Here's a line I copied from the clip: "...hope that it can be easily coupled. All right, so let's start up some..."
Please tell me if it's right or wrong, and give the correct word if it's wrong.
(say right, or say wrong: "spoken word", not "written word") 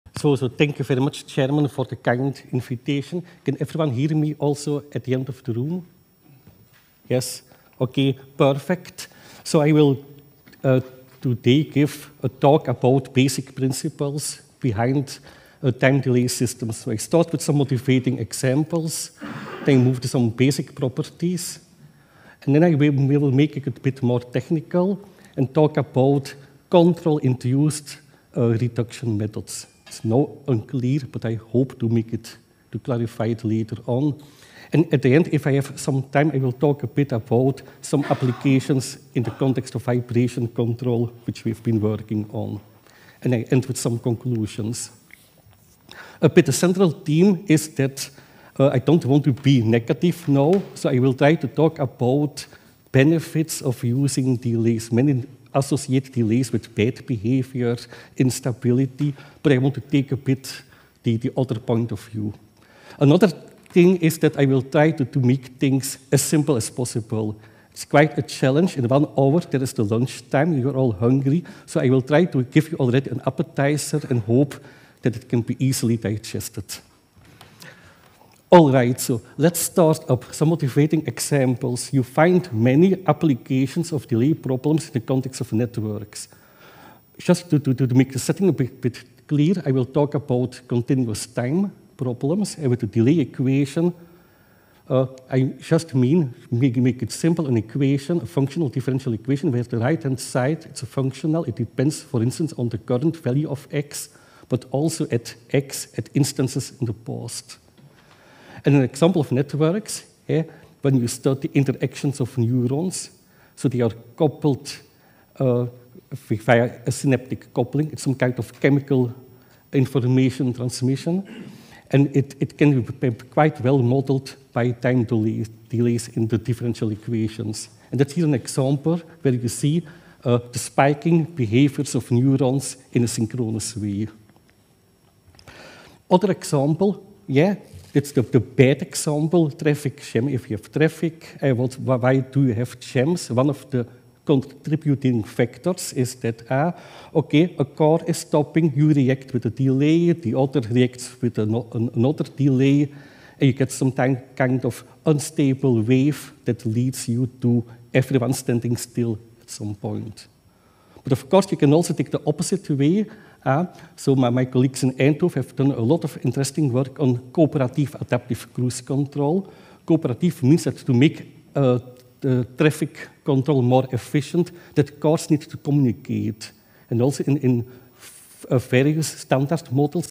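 wrong: "digested", not "coupled".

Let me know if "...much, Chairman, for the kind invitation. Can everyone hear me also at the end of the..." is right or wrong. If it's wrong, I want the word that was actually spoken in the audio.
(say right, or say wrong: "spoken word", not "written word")
right.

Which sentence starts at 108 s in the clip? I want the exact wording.
And an example of networks, eh, when you study interactions of neurons, so they are coupled uh, via a synaptic coupling.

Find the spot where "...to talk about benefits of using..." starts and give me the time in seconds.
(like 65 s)
51 s.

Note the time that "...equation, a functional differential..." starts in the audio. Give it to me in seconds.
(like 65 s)
97 s.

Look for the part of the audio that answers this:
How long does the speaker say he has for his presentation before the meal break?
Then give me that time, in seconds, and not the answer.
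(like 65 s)
68 s.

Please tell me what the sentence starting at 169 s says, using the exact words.
Cooperative means that to make uh, uh, traffic control more efficient, that cars need to communicate.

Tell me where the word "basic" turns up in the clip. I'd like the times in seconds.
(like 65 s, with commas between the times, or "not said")
13 s, 20 s.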